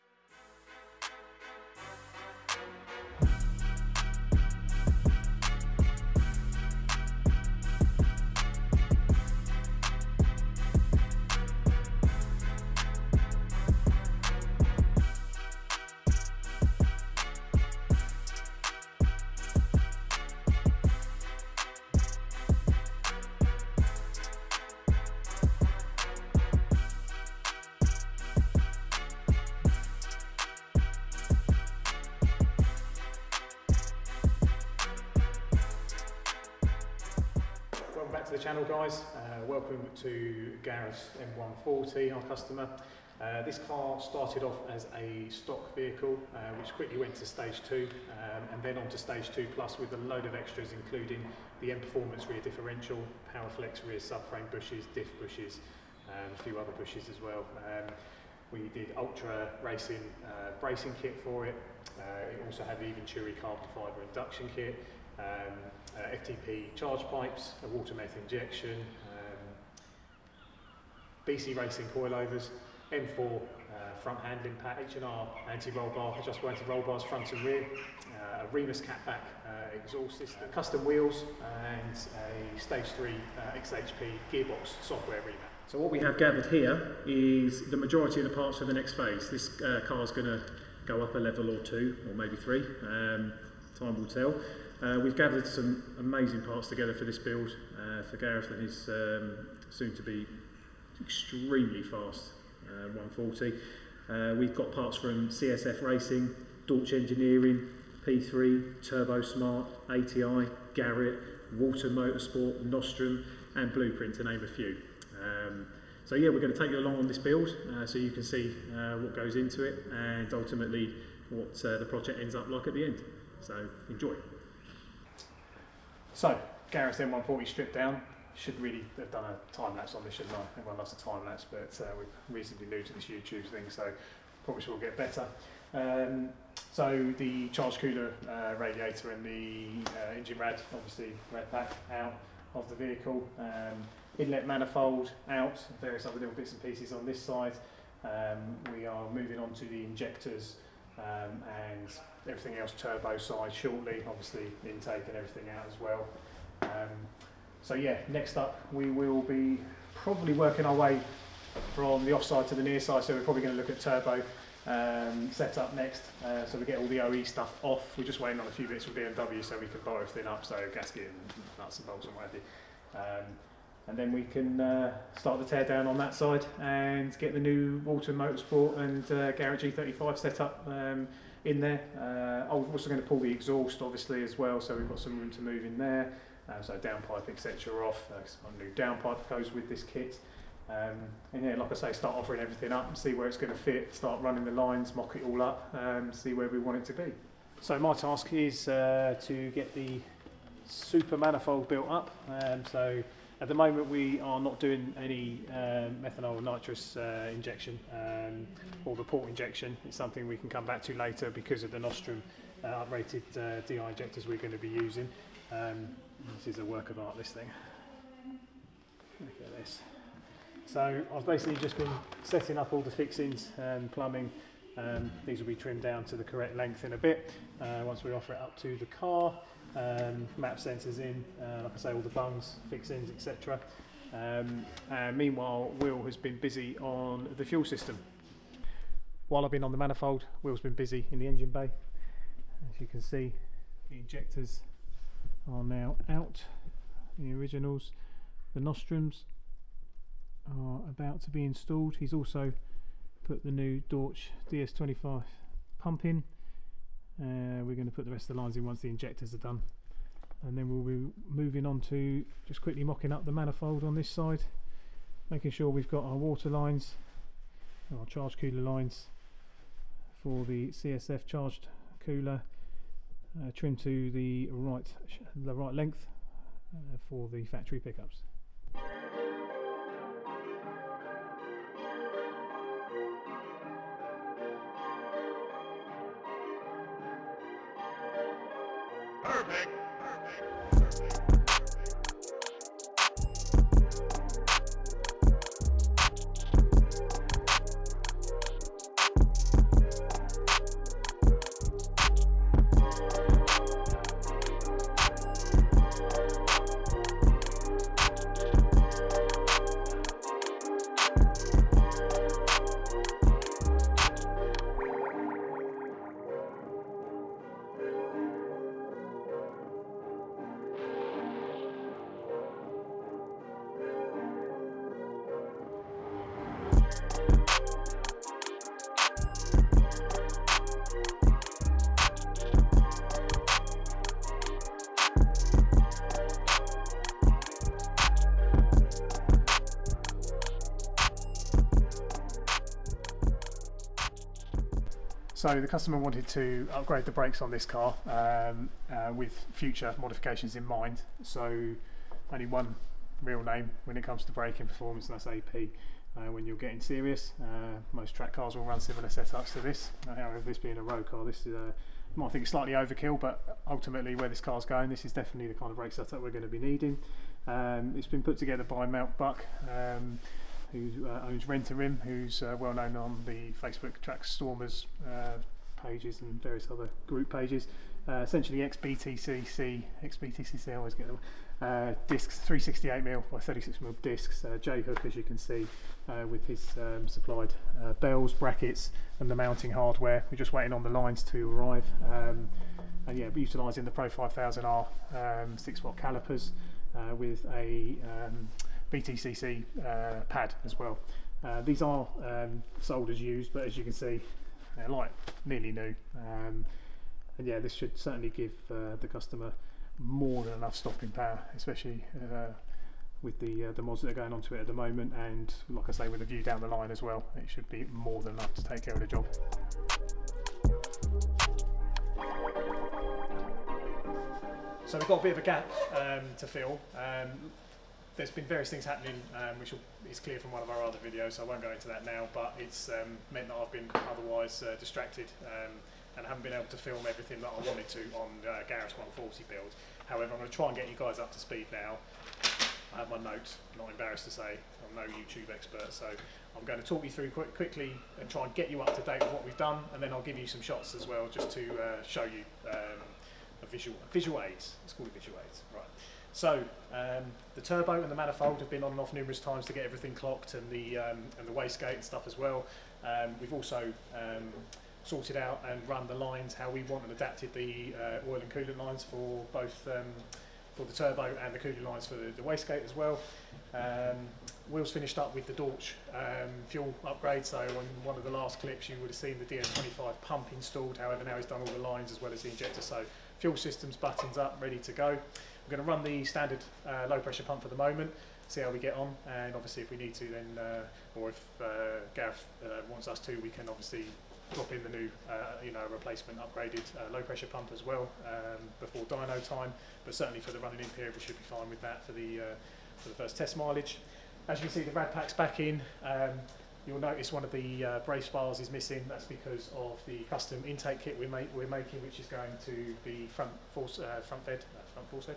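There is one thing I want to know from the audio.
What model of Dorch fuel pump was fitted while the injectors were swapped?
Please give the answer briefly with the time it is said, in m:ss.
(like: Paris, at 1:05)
DS25, at 4:14.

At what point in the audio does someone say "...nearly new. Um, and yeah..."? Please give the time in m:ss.
6:45.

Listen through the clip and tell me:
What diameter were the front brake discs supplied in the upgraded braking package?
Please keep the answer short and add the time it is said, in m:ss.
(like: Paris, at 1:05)
368mm, at 6:22.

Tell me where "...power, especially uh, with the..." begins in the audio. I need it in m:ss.
6:51.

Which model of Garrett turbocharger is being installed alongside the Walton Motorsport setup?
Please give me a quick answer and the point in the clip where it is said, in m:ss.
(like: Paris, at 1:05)
G35, at 2:59.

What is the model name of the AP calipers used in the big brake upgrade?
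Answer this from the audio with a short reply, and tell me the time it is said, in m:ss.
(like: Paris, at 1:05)
Pro 5000R, at 6:33.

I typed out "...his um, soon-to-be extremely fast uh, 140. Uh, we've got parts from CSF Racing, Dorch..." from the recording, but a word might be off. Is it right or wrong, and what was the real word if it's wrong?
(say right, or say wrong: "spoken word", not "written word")
right.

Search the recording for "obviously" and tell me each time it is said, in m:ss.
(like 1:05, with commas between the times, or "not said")
2:20, 2:34, 3:03, 8:09, 8:13.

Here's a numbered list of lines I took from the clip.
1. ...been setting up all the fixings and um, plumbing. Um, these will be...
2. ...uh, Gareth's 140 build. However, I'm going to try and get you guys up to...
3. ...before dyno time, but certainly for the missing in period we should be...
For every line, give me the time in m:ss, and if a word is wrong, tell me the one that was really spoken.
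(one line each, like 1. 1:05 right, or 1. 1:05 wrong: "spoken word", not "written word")
1. 3:41 right
2. 7:18 right
3. 8:18 wrong: "running", not "missing".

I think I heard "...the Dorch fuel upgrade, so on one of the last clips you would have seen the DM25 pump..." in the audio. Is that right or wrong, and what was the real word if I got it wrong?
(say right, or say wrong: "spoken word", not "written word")
right.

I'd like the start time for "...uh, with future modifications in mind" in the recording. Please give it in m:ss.
5:48.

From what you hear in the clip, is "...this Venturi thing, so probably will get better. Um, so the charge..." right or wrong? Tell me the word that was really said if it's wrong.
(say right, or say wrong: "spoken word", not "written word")
wrong: "YouTube", not "Venturi".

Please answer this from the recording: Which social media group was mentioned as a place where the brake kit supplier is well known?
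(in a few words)
Track Stormers.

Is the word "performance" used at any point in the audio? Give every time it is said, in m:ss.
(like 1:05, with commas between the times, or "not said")
0:51, 5:54.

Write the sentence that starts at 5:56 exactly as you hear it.
Uh, when you're getting serious, uh, most track cars will run similar setups to this.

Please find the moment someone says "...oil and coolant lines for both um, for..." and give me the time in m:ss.
7:48.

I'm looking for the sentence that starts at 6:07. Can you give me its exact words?
Um, it's been put together by Mount Buck.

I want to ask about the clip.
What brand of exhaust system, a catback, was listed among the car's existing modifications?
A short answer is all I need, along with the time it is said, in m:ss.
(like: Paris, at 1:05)
Remus, at 1:18.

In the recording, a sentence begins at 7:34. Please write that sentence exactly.
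It's called a visual aids, right.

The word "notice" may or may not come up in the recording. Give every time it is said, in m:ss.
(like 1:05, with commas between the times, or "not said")
8:26.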